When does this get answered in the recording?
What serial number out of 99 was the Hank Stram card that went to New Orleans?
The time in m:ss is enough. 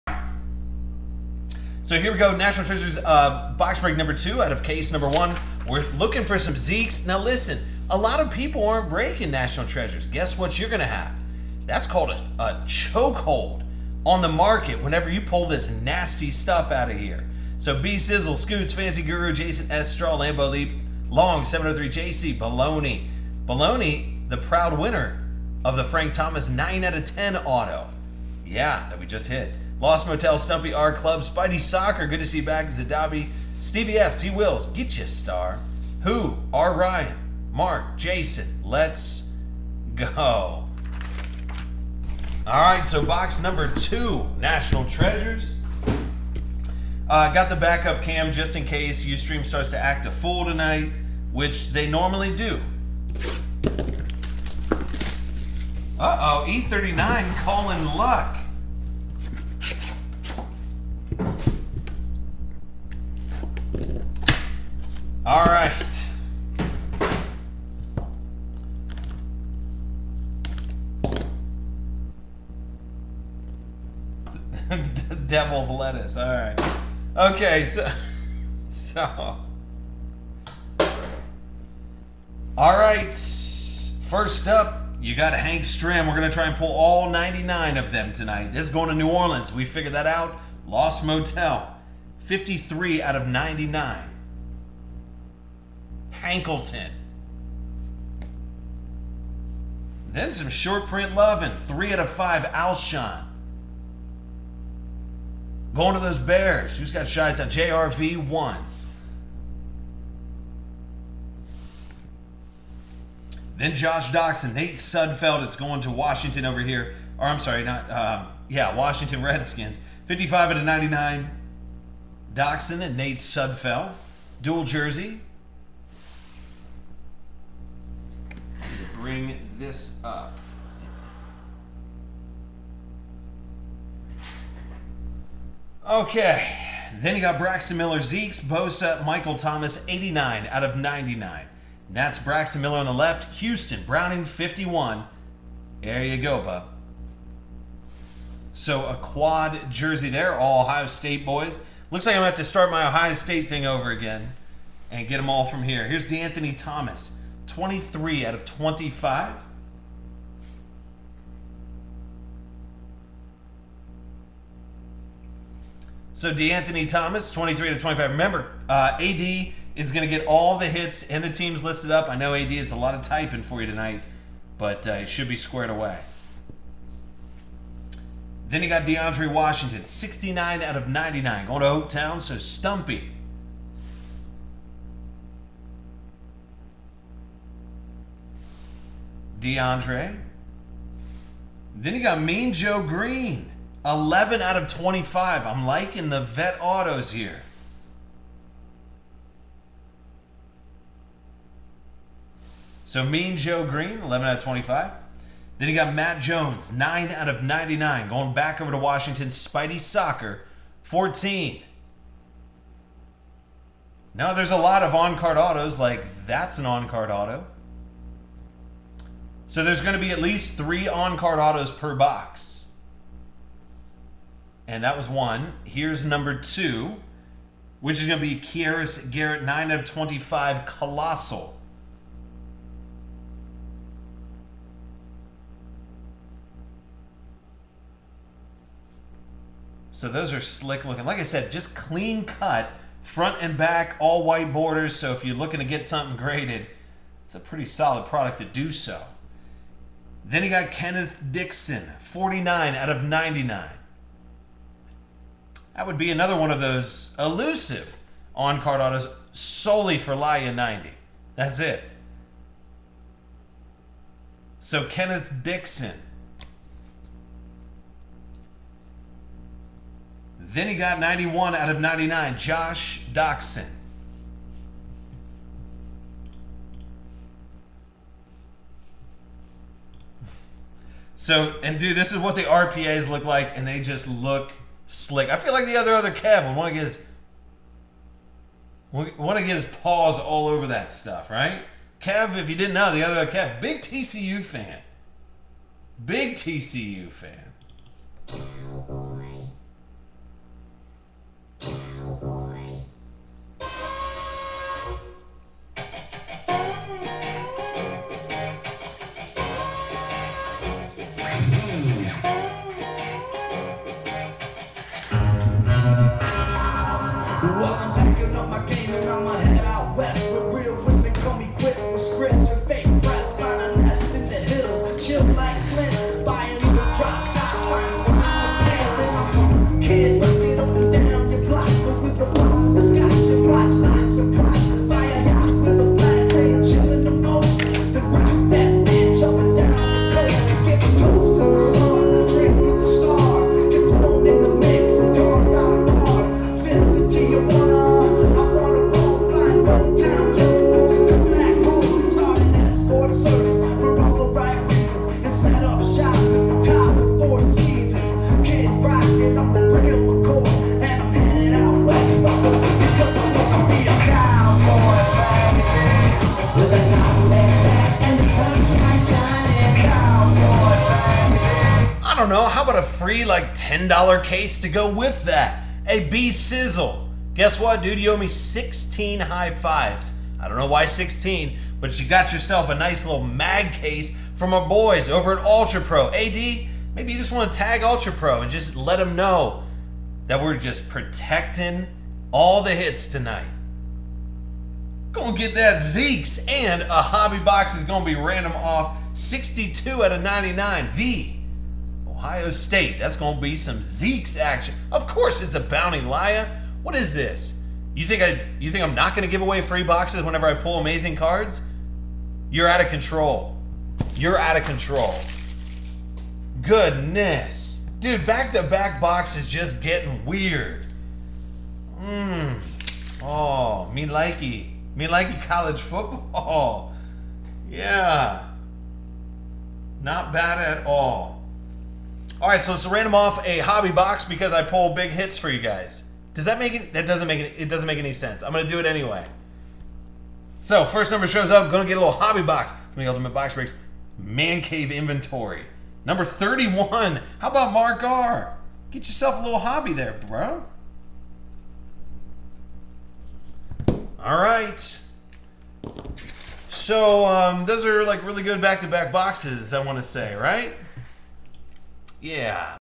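1:32.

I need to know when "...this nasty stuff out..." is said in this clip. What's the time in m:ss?
0:15.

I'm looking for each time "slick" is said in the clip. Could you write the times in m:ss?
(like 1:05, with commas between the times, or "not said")
4:00, 4:44.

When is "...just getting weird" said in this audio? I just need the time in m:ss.
6:59.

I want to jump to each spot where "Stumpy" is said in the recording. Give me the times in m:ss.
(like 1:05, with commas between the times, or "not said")
0:30, 3:02.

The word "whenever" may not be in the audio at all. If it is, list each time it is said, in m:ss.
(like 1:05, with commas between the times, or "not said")
0:14, 6:50.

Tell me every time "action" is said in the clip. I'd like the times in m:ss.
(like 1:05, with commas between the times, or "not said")
6:44.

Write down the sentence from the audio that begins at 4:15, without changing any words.
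That would be another one of those elusive on card autos solely for Laya 90.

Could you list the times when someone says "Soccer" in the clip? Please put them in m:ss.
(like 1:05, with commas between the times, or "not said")
0:31, 3:29.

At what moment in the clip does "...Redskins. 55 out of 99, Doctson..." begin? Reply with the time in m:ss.
1:59.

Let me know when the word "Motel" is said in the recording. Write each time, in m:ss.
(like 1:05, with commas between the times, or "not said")
0:30, 1:31.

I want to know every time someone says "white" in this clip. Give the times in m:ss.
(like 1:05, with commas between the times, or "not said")
4:04.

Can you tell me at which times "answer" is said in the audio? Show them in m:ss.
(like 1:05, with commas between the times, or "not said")
not said.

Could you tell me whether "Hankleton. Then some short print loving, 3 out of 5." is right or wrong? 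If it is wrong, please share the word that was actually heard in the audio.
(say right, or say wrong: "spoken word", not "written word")
right.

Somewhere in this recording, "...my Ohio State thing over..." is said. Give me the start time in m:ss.
2:32.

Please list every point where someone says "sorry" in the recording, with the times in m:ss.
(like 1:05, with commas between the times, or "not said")
1:57.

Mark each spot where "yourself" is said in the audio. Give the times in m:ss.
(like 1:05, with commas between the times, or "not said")
6:22, 7:29.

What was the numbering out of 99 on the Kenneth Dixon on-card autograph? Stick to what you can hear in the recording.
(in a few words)
49.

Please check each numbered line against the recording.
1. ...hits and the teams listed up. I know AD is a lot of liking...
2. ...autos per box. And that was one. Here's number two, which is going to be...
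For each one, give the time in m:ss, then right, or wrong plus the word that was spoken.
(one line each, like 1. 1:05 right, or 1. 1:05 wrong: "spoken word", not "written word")
1. 2:50 wrong: "typing", not "liking"
2. 3:41 right.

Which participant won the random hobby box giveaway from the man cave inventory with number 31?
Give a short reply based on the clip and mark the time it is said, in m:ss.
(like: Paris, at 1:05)
Mark R, at 7:27.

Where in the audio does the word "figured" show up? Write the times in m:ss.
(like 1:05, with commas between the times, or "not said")
1:29.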